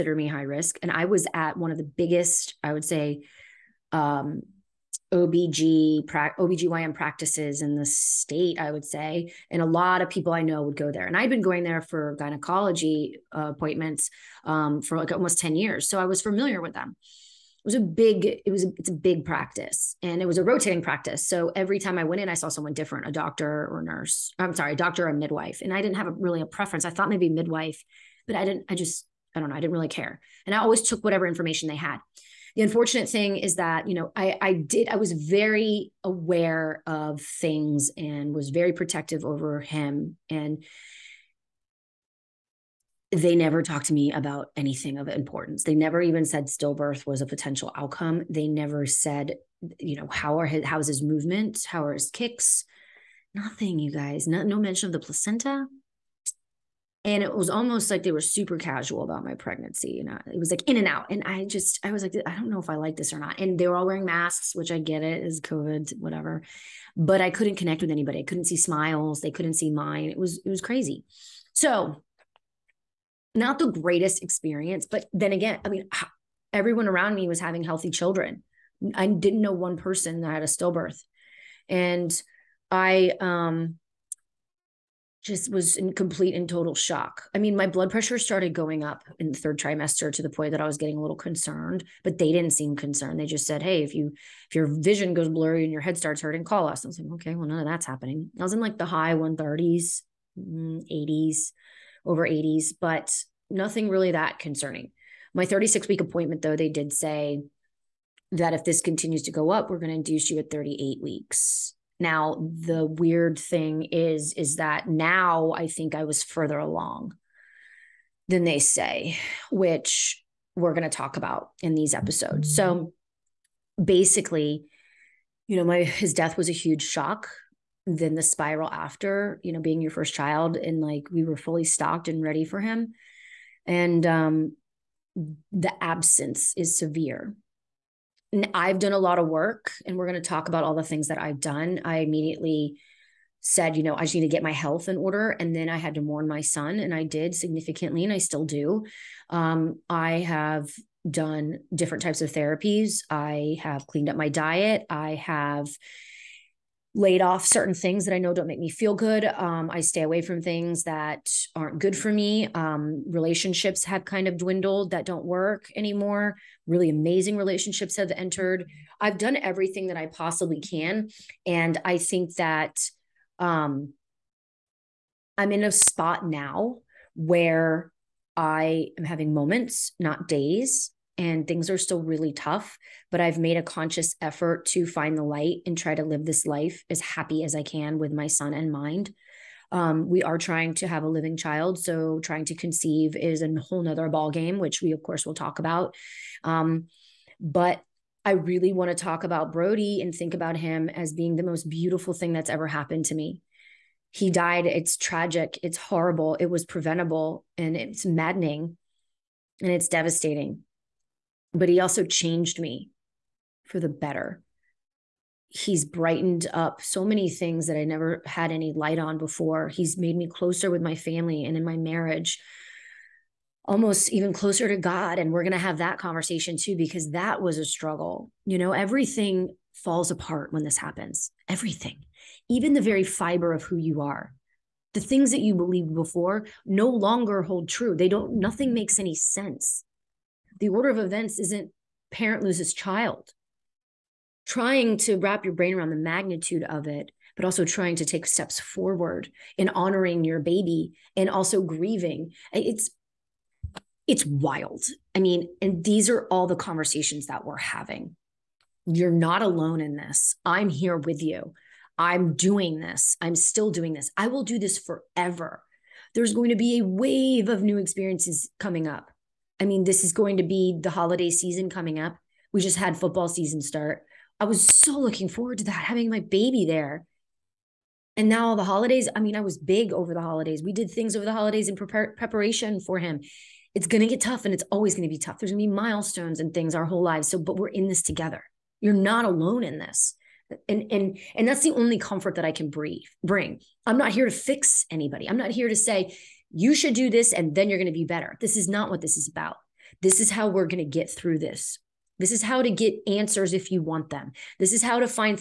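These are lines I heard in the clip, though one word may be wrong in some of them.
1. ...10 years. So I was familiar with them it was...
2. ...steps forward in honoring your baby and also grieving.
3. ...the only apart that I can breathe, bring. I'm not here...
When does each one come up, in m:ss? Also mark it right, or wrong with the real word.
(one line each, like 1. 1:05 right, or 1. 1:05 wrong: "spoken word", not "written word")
1. 0:15 right
2. 4:08 right
3. 4:51 wrong: "comfort", not "apart".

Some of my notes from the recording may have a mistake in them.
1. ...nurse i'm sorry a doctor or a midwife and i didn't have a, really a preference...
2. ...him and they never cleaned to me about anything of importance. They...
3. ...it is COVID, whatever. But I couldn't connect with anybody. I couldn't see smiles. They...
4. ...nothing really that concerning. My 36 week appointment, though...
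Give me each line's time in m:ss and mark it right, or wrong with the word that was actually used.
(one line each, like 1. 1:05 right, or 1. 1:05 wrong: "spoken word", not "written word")
1. 0:23 right
2. 0:39 wrong: "talked", not "cleaned"
3. 1:05 right
4. 1:43 right.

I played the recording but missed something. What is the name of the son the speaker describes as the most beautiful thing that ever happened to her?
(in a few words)
Brody.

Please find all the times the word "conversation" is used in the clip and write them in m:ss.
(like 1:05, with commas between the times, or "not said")
3:45, 4:16.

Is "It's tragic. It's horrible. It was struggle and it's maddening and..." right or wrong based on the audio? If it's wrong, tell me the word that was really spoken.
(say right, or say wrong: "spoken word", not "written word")
wrong: "preventable", not "struggle".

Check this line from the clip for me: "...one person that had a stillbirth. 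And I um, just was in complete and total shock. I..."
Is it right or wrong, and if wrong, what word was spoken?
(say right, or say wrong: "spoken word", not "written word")
right.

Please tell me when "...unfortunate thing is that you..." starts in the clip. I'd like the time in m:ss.
0:32.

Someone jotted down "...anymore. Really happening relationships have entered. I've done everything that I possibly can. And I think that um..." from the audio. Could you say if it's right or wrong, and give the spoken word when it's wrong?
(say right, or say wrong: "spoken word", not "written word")
wrong: "amazing", not "happening".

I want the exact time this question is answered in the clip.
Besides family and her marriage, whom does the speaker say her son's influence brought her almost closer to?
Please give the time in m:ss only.
3:44.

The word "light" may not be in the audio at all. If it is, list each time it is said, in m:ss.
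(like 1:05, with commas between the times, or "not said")
3:05, 3:38.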